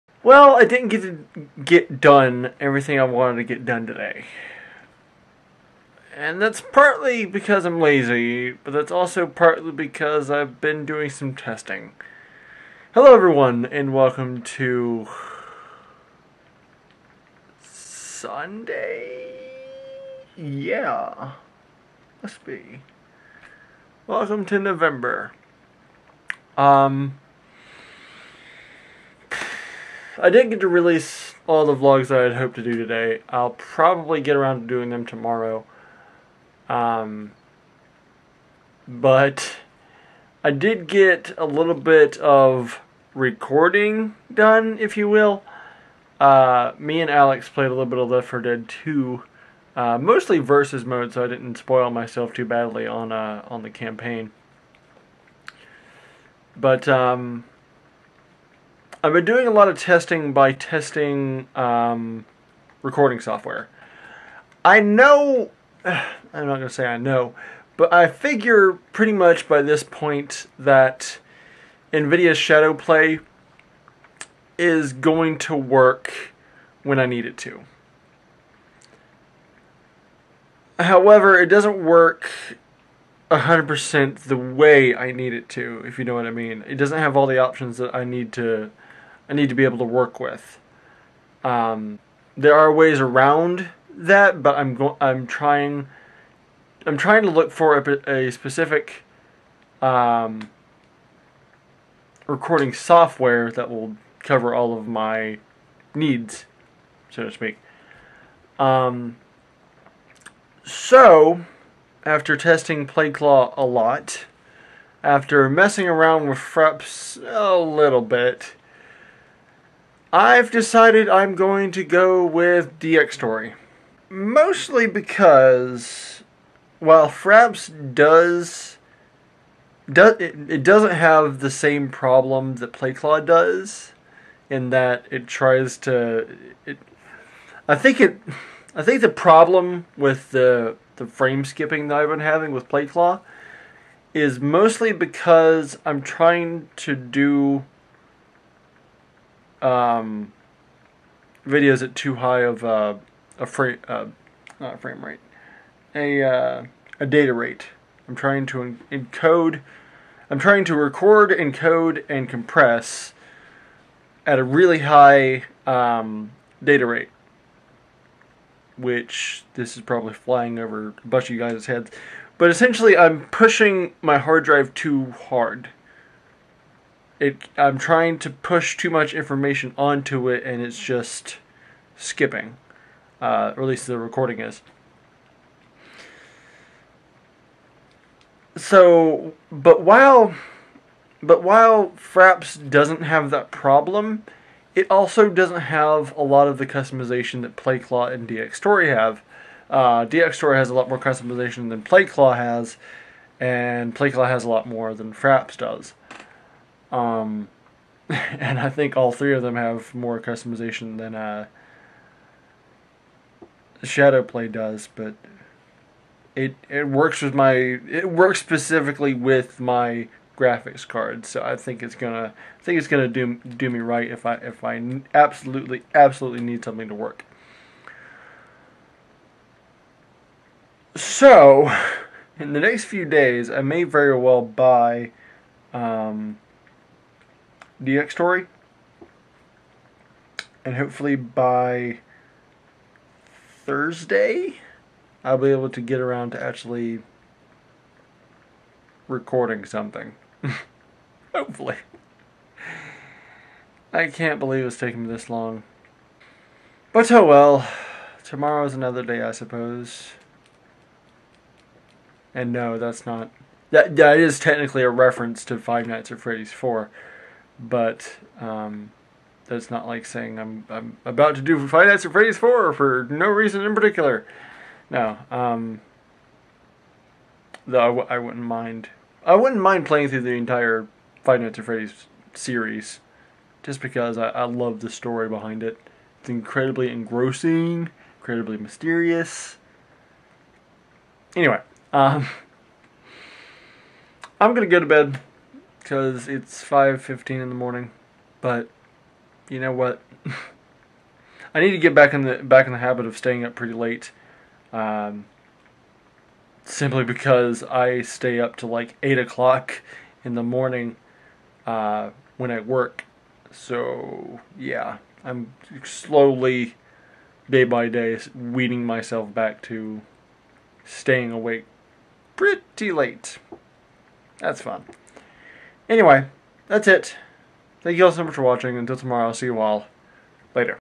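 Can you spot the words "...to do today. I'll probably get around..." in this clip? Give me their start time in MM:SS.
00:32.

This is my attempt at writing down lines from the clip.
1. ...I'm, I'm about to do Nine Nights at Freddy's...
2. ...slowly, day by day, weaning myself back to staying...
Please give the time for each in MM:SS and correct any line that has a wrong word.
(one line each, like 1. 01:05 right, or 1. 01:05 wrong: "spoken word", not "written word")
1. 04:30 wrong: "Five", not "Nine"
2. 05:15 right.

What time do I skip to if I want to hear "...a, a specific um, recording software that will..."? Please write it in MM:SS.
01:37.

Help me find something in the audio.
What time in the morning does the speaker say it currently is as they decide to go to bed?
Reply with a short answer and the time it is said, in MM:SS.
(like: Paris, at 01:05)
5:15, at 04:56.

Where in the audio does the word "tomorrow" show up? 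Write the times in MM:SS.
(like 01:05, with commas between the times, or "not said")
00:35, 04:18, 05:28.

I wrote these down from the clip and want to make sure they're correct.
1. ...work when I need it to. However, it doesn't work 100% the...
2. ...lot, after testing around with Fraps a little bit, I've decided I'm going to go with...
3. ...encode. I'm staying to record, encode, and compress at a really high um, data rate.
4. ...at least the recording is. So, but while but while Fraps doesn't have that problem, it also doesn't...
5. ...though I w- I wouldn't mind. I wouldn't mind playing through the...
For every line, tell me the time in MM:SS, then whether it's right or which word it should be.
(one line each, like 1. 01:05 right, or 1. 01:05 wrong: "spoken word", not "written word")
1. 01:15 right
2. 01:53 wrong: "messing", not "testing"
3. 02:38 wrong: "trying", not "staying"
4. 03:03 right
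5. 04:37 right.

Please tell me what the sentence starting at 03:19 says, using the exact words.
Uh, Dxtory has a lot more customization than Playclaw has, and Playclaw has a lot more than Fraps does.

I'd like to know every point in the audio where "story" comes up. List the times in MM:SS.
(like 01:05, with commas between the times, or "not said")
04:44.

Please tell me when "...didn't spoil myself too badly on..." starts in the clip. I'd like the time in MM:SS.
00:51.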